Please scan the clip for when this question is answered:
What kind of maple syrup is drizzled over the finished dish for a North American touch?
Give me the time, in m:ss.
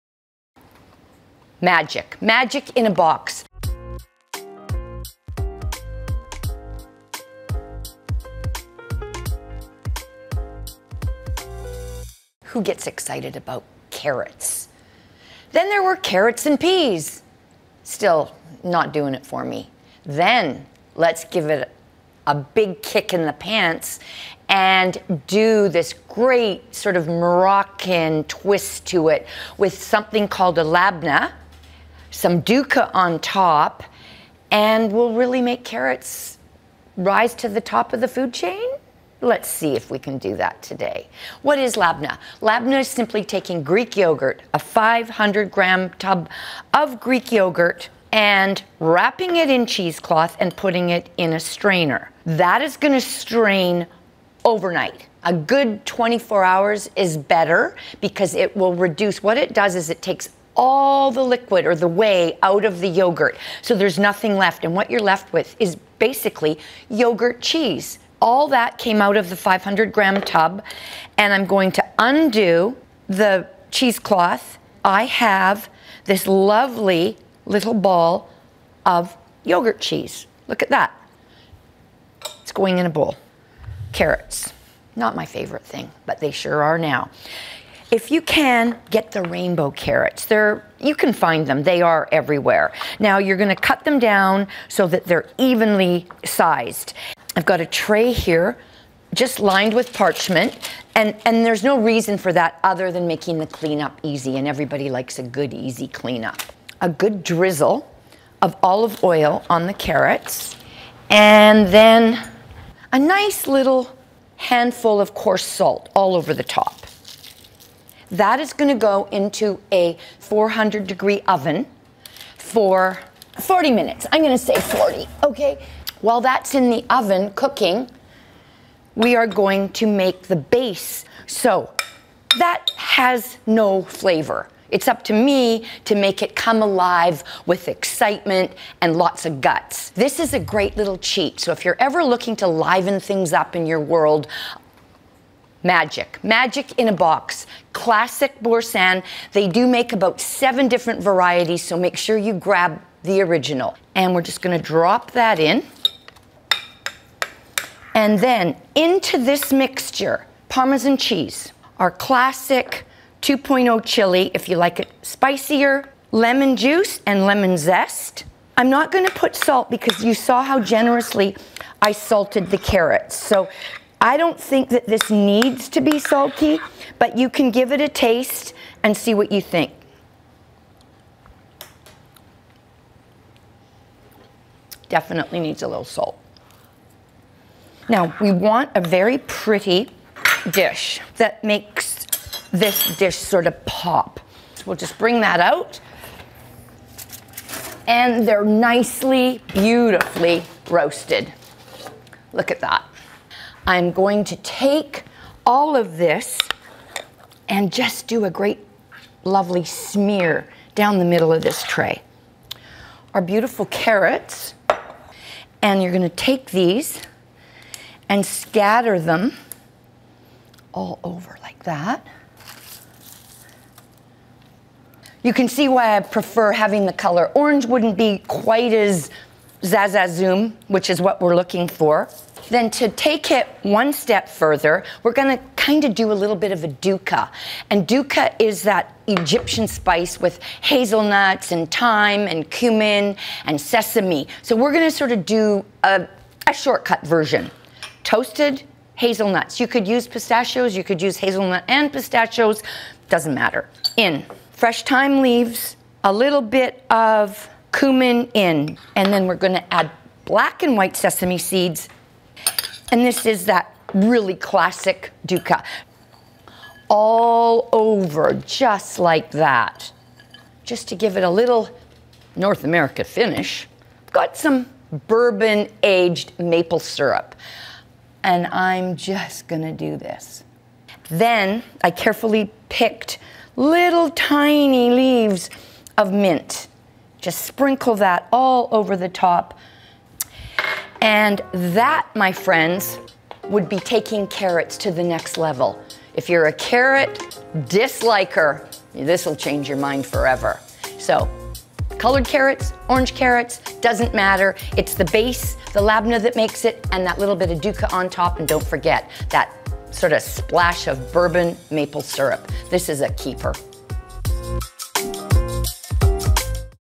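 4:35.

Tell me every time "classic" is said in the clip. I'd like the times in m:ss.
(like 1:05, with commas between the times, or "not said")
2:27, 2:41, 4:24.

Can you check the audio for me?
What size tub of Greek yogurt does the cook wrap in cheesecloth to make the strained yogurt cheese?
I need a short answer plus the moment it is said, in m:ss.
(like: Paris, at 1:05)
500 grams, at 0:44.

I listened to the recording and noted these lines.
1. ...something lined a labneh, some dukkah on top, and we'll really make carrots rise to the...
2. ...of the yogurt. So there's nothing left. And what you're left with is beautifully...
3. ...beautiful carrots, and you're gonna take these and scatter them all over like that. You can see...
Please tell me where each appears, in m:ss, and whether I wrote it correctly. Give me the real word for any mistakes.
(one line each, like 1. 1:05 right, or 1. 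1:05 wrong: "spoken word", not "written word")
1. 0:29 wrong: "called", not "lined"
2. 1:02 wrong: "basically", not "beautifully"
3. 3:33 right.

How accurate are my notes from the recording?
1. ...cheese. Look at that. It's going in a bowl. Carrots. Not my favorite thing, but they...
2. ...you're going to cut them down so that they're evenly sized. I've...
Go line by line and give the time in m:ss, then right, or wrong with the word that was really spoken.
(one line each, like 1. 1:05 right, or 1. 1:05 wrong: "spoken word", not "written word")
1. 1:19 right
2. 1:33 right.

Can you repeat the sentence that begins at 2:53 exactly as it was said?
So I don't think that this needs to be sulky, but you can give it a taste and see what you think.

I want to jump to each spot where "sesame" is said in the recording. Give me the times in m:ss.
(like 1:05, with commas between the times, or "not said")
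4:03, 4:20.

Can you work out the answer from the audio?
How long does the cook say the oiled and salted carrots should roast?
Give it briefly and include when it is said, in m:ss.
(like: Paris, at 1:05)
40 minutes, at 2:03.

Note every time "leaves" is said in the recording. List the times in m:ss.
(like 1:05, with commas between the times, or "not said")
4:15, 4:44.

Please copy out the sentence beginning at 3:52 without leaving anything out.
Then to take it one step further, we're going to kind of do a little bit of a dukkah.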